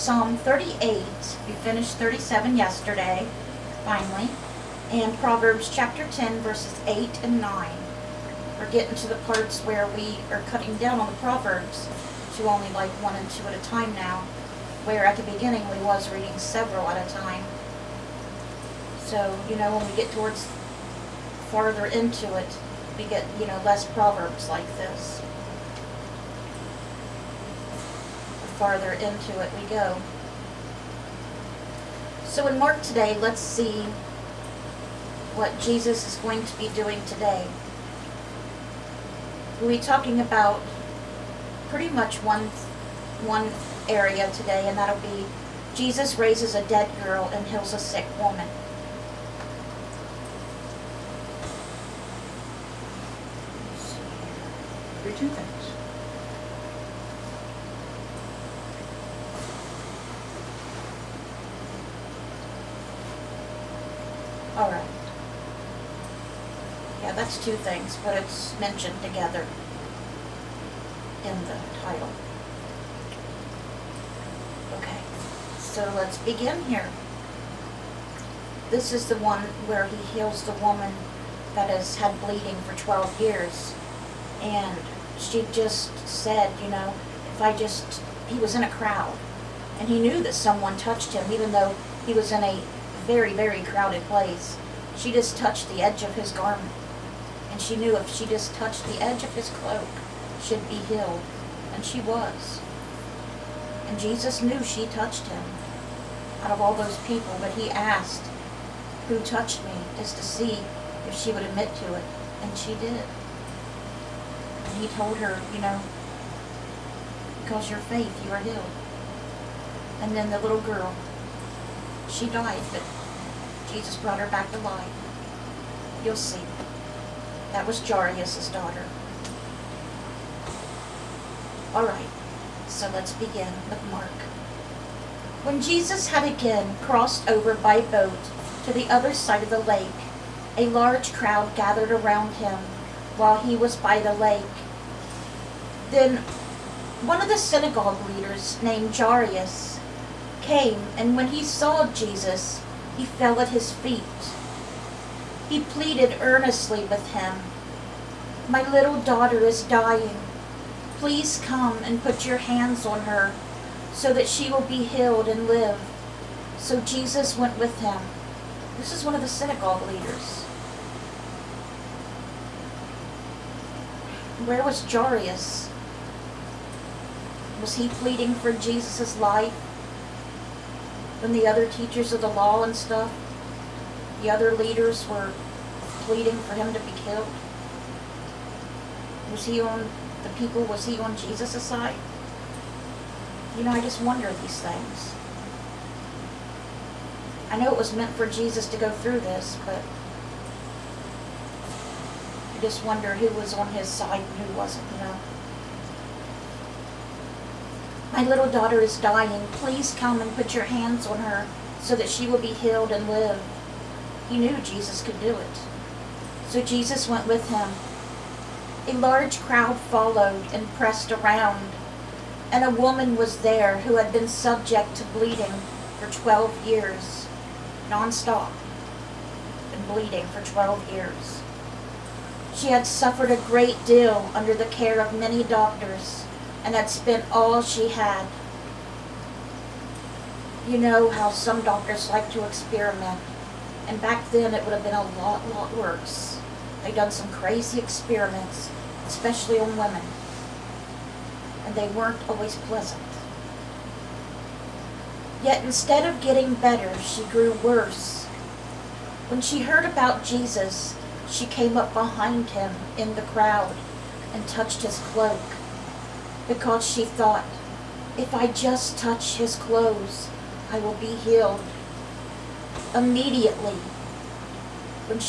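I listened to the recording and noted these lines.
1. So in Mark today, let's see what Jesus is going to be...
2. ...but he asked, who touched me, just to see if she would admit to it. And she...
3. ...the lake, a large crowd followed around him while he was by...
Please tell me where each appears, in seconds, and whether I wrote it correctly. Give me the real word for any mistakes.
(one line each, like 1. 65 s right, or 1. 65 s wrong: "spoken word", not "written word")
1. 32 s right
2. 107 s right
3. 139 s wrong: "gathered", not "followed".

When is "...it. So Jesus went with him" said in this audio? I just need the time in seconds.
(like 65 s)
215 s.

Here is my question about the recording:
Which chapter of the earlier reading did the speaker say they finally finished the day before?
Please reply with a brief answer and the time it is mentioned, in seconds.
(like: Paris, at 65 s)
37, at 1 s.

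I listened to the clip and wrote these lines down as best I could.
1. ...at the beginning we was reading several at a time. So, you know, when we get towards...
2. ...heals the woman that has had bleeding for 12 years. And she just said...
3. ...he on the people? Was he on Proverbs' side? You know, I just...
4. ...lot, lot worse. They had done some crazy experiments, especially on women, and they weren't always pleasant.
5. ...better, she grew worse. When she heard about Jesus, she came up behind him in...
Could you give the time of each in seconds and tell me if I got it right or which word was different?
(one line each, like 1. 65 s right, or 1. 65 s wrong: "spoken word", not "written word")
1. 15 s right
2. 80 s right
3. 189 s wrong: "Jesus", not "Proverbs"
4. 245 s right
5. 256 s right.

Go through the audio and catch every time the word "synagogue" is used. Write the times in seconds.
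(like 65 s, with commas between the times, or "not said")
147 s, 169 s.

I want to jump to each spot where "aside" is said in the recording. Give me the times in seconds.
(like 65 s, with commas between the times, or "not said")
not said.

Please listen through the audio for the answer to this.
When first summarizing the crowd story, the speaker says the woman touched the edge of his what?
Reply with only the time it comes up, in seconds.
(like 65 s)
96 s.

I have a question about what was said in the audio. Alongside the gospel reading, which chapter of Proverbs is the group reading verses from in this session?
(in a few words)
10.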